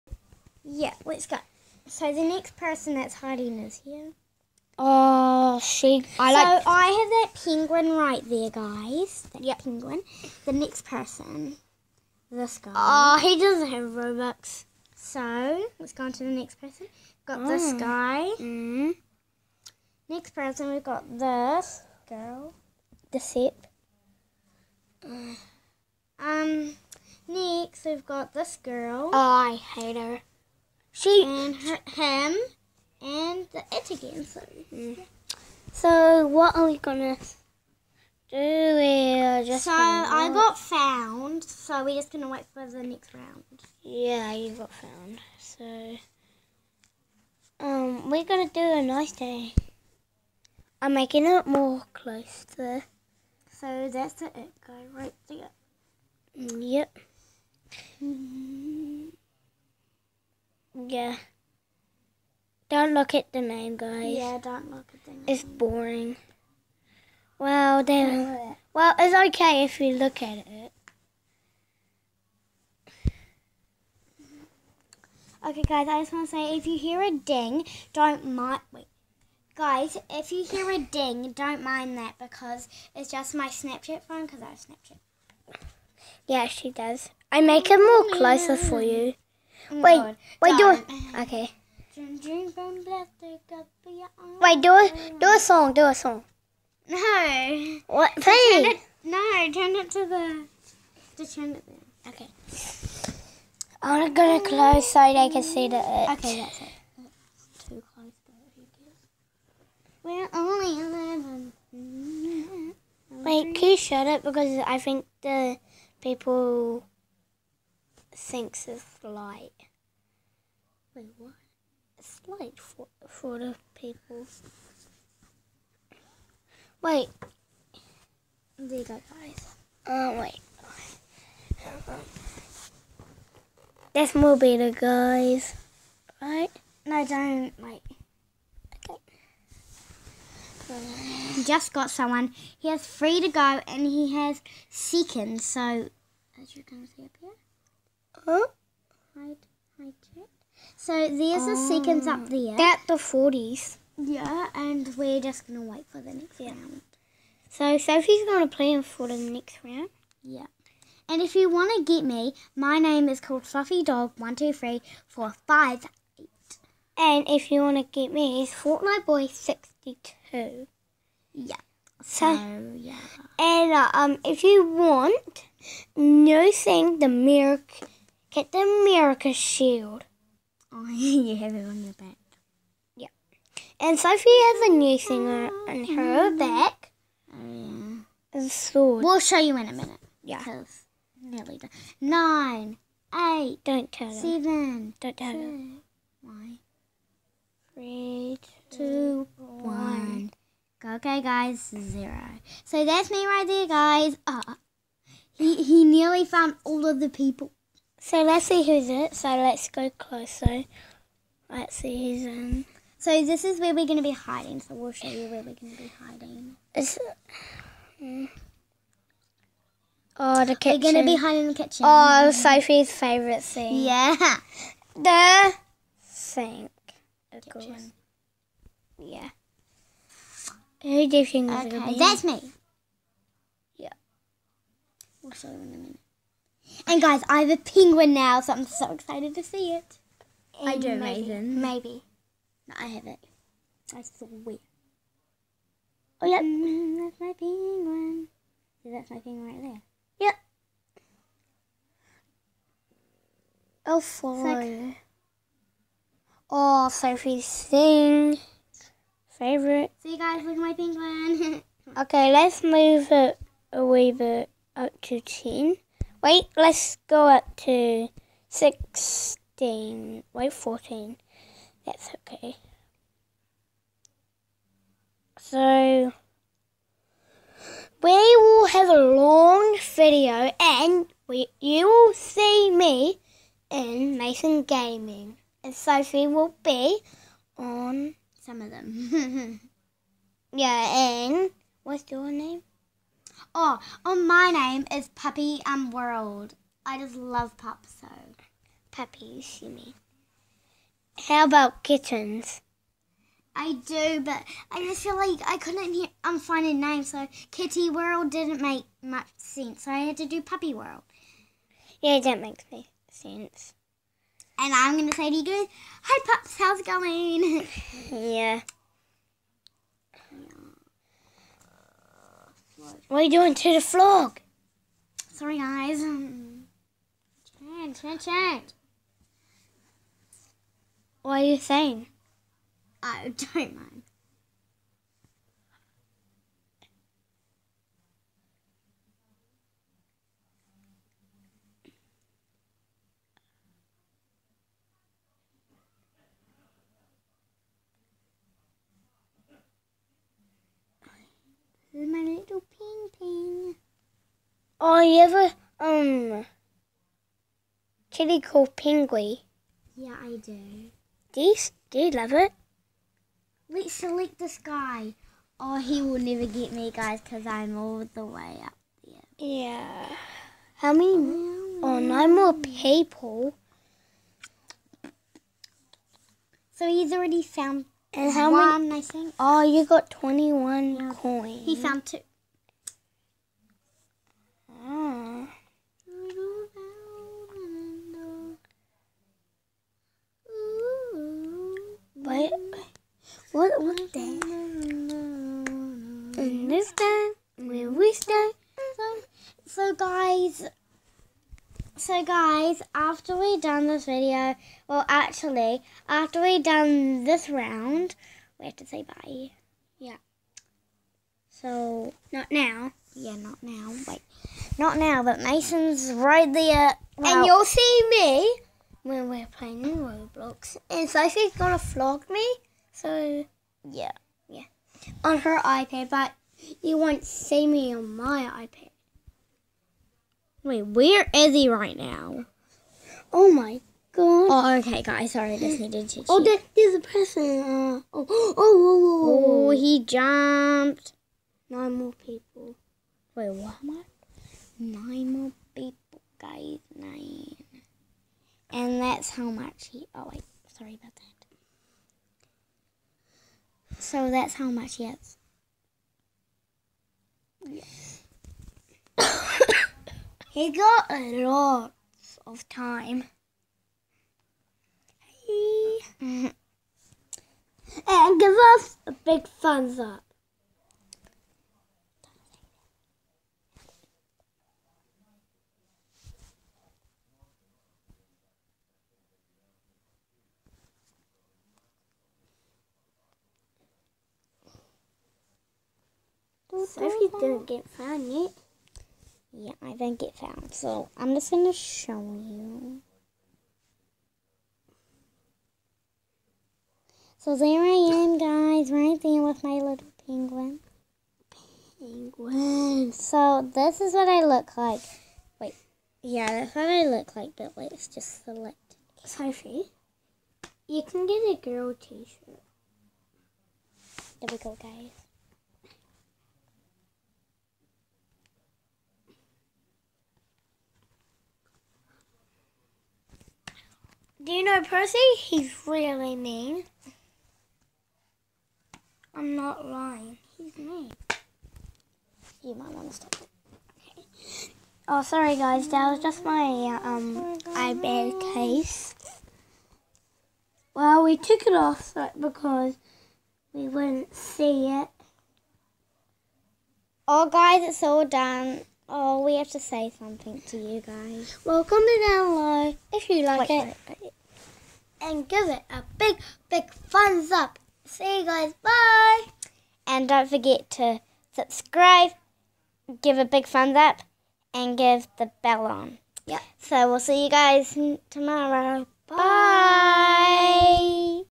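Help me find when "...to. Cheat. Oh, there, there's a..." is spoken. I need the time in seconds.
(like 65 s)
436 s.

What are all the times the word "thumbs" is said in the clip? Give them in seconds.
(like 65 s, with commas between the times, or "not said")
469 s, 556 s, 563 s.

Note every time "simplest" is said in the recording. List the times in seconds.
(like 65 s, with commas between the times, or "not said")
not said.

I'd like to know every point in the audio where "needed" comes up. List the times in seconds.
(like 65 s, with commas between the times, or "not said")
435 s.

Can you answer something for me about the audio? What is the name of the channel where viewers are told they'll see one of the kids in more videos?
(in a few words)
Mason Gaming.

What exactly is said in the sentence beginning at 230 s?
Who do you think okay, that's me.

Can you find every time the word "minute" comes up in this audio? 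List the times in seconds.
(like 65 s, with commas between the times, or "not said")
189 s, 235 s.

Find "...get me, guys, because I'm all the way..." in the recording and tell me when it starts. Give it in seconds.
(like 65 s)
366 s.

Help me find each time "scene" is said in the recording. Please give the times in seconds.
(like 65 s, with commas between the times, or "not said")
223 s.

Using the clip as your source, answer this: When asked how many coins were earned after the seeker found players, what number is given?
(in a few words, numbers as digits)
21.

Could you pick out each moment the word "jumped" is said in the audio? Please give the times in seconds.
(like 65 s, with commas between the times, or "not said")
440 s.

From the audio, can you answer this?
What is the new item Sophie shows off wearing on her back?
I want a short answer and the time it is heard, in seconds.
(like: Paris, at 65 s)
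A sword, at 188 s.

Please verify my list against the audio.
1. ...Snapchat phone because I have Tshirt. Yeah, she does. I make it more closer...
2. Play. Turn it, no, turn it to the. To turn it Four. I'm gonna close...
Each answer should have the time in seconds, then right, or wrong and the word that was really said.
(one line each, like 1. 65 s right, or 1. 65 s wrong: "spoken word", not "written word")
1. 83 s wrong: "Snapchat", not "Tshirt"
2. 98 s wrong: "Okay", not "Four".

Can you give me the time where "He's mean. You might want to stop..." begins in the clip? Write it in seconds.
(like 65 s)
530 s.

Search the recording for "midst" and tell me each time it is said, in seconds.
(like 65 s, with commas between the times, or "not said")
not said.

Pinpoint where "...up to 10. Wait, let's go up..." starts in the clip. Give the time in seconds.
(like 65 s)
264 s.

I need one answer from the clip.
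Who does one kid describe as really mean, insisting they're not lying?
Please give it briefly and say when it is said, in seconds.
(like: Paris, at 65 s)
Percy, at 524 s.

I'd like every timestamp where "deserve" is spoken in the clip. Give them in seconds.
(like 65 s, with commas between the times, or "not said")
not said.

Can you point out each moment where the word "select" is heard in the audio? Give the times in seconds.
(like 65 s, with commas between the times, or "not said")
363 s, 508 s.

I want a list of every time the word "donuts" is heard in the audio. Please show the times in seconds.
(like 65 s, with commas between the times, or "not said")
not said.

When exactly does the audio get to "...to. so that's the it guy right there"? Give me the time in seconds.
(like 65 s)
52 s.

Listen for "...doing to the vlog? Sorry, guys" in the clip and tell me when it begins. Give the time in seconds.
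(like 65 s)
323 s.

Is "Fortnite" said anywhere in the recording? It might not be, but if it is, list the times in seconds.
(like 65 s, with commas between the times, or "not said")
168 s.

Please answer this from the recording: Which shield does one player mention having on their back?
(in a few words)
America Shield.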